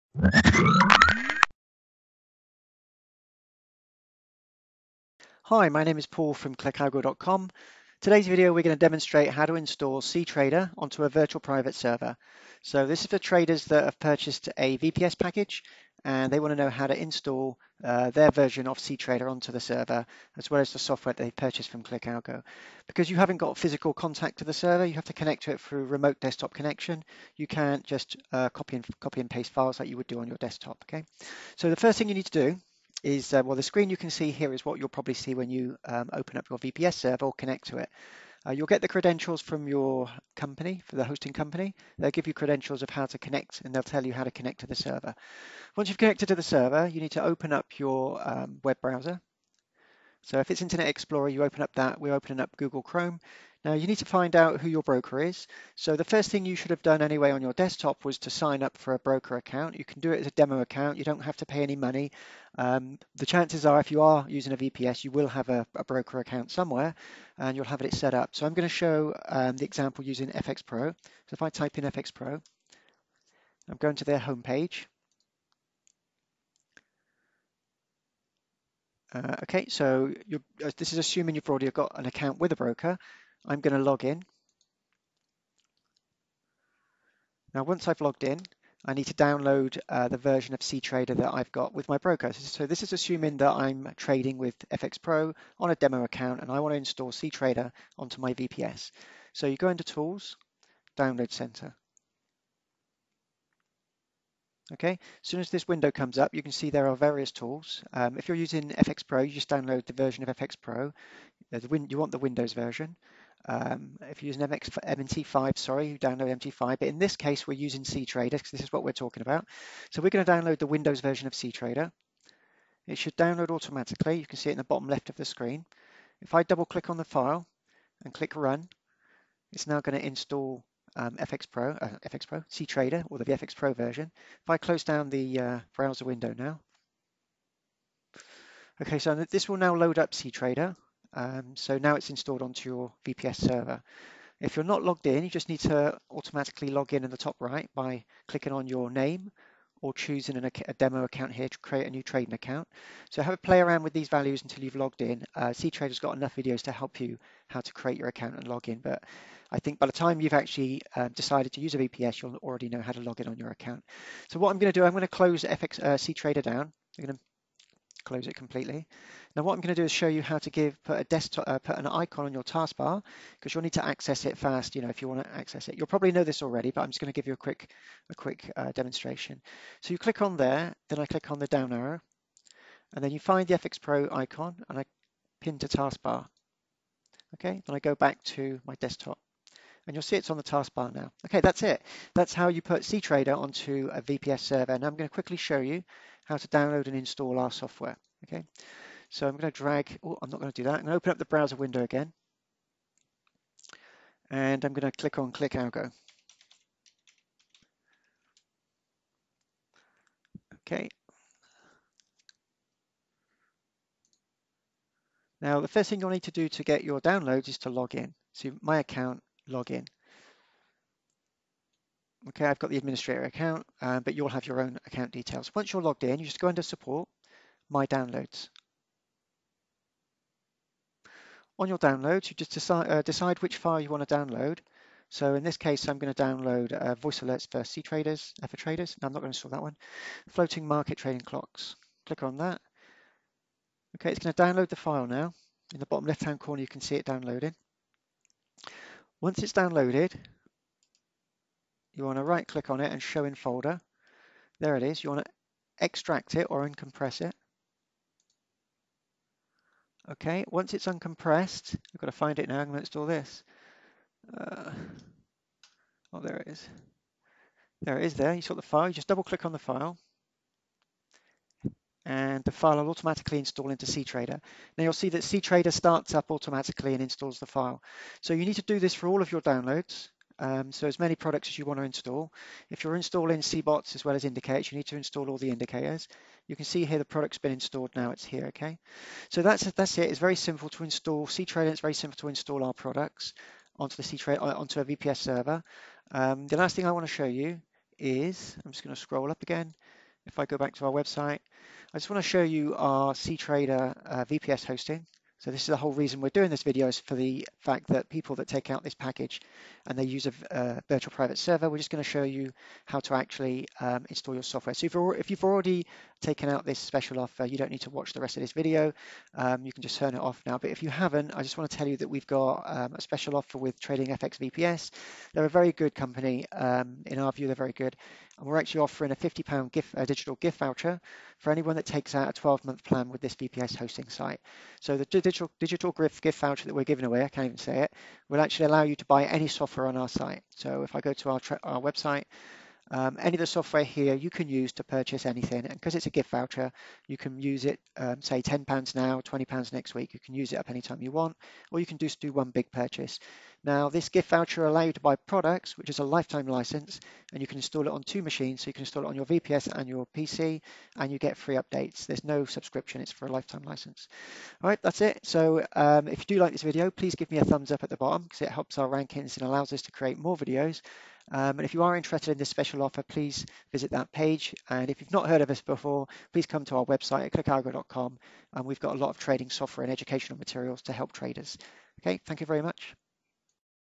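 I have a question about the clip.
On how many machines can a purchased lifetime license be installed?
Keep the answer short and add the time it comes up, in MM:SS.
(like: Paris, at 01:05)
2, at 05:58.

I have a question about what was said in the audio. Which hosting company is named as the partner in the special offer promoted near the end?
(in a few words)
Trading FX VPS.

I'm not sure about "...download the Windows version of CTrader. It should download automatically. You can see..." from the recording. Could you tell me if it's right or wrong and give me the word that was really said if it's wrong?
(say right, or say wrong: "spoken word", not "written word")
right.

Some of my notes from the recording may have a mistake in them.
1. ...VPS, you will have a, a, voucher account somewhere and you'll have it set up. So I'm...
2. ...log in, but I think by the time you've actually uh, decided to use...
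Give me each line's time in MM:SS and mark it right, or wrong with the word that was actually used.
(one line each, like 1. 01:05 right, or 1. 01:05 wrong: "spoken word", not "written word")
1. 01:04 wrong: "broker", not "voucher"
2. 02:38 right.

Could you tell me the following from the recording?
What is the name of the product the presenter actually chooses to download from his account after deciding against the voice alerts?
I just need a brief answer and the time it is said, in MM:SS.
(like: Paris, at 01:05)
Floating market trading clocks, at 04:00.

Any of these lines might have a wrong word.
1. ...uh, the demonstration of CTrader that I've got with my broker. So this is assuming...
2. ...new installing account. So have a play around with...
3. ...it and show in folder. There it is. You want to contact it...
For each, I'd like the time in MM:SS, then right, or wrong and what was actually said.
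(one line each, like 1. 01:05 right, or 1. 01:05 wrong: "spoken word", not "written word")
1. 01:29 wrong: "version", not "demonstration"
2. 02:31 wrong: "trading", not "installing"
3. 04:12 wrong: "extract", not "contact".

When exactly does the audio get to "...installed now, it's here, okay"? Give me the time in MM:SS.
04:47.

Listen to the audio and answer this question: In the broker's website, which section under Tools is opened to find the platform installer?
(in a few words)
Download Center.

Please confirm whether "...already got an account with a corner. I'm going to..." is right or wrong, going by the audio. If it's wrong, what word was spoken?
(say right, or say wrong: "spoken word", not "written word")
wrong: "broker", not "corner".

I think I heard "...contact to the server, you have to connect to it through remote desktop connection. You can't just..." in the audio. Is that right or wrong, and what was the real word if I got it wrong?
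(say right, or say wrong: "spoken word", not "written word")
right.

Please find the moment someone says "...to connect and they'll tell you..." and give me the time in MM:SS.
00:43.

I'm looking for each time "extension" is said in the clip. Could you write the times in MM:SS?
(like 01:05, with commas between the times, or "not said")
not said.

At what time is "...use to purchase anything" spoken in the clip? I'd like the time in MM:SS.
05:44.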